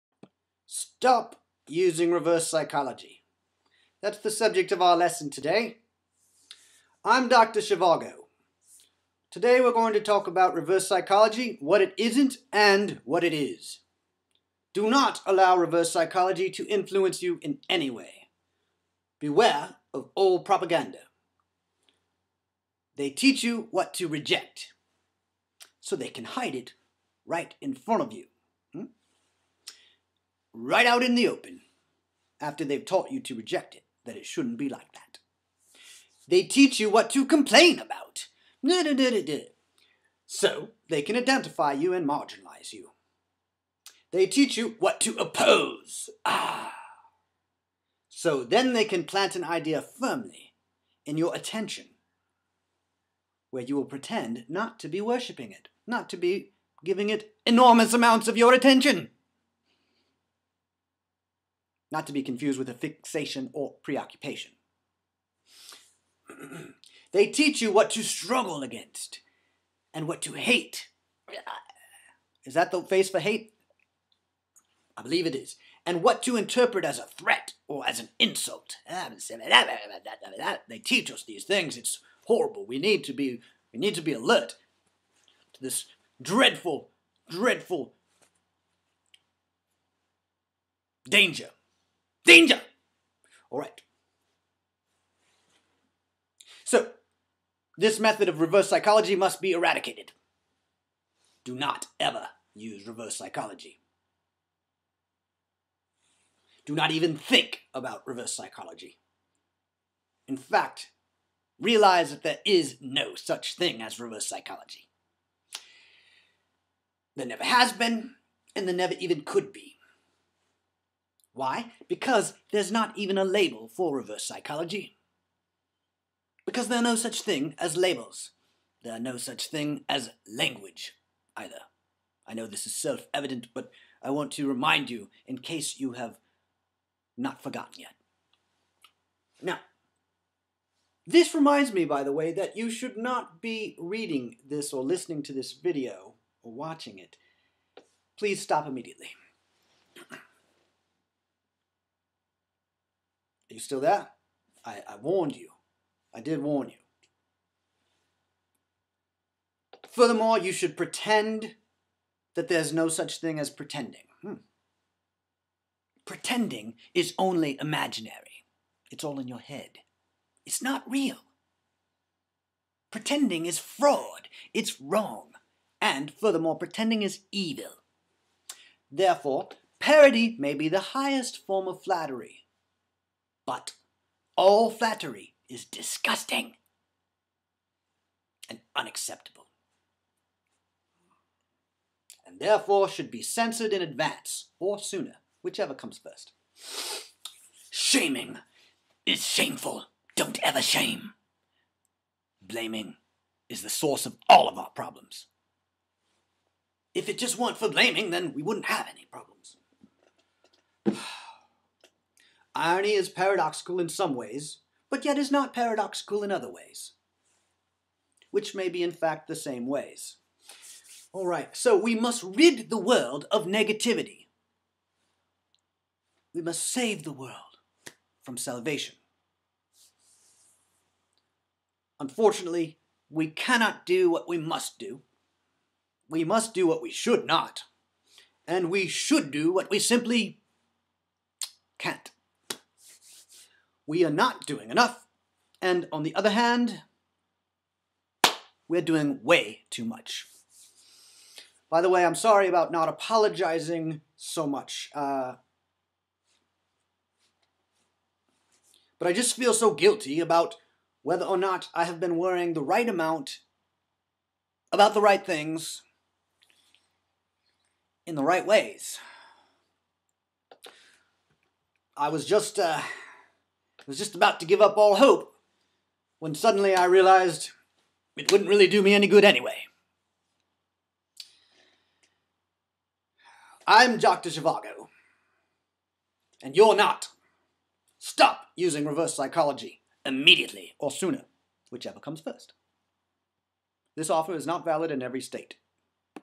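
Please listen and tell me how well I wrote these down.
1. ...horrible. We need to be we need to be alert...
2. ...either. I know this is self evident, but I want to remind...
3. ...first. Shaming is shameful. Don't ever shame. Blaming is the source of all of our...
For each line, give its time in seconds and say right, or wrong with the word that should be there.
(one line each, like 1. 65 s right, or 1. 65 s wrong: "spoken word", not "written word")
1. 82 s right
2. 131 s right
3. 195 s right.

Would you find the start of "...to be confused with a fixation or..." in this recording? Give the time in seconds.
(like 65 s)
62 s.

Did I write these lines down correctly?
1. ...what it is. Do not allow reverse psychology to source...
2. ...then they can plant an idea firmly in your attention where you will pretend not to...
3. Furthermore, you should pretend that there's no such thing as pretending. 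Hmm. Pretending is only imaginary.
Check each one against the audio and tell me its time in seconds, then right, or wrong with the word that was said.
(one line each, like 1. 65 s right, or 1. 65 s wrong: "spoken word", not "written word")
1. 13 s wrong: "influence", not "source"
2. 48 s right
3. 159 s right.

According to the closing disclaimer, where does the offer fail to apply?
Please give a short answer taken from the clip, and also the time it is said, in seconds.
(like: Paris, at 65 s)
in every state, at 294 s.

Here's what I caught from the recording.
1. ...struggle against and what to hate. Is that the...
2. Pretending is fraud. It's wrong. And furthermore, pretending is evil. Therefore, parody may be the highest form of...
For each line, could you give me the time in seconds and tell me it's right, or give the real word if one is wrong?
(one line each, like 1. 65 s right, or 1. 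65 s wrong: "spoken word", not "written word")
1. 68 s right
2. 172 s right.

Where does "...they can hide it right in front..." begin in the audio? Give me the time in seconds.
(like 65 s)
25 s.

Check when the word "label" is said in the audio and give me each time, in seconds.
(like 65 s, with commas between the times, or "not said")
123 s, 127 s.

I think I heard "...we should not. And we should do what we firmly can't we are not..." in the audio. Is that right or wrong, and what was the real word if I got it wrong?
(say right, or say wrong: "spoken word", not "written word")
wrong: "simply", not "firmly".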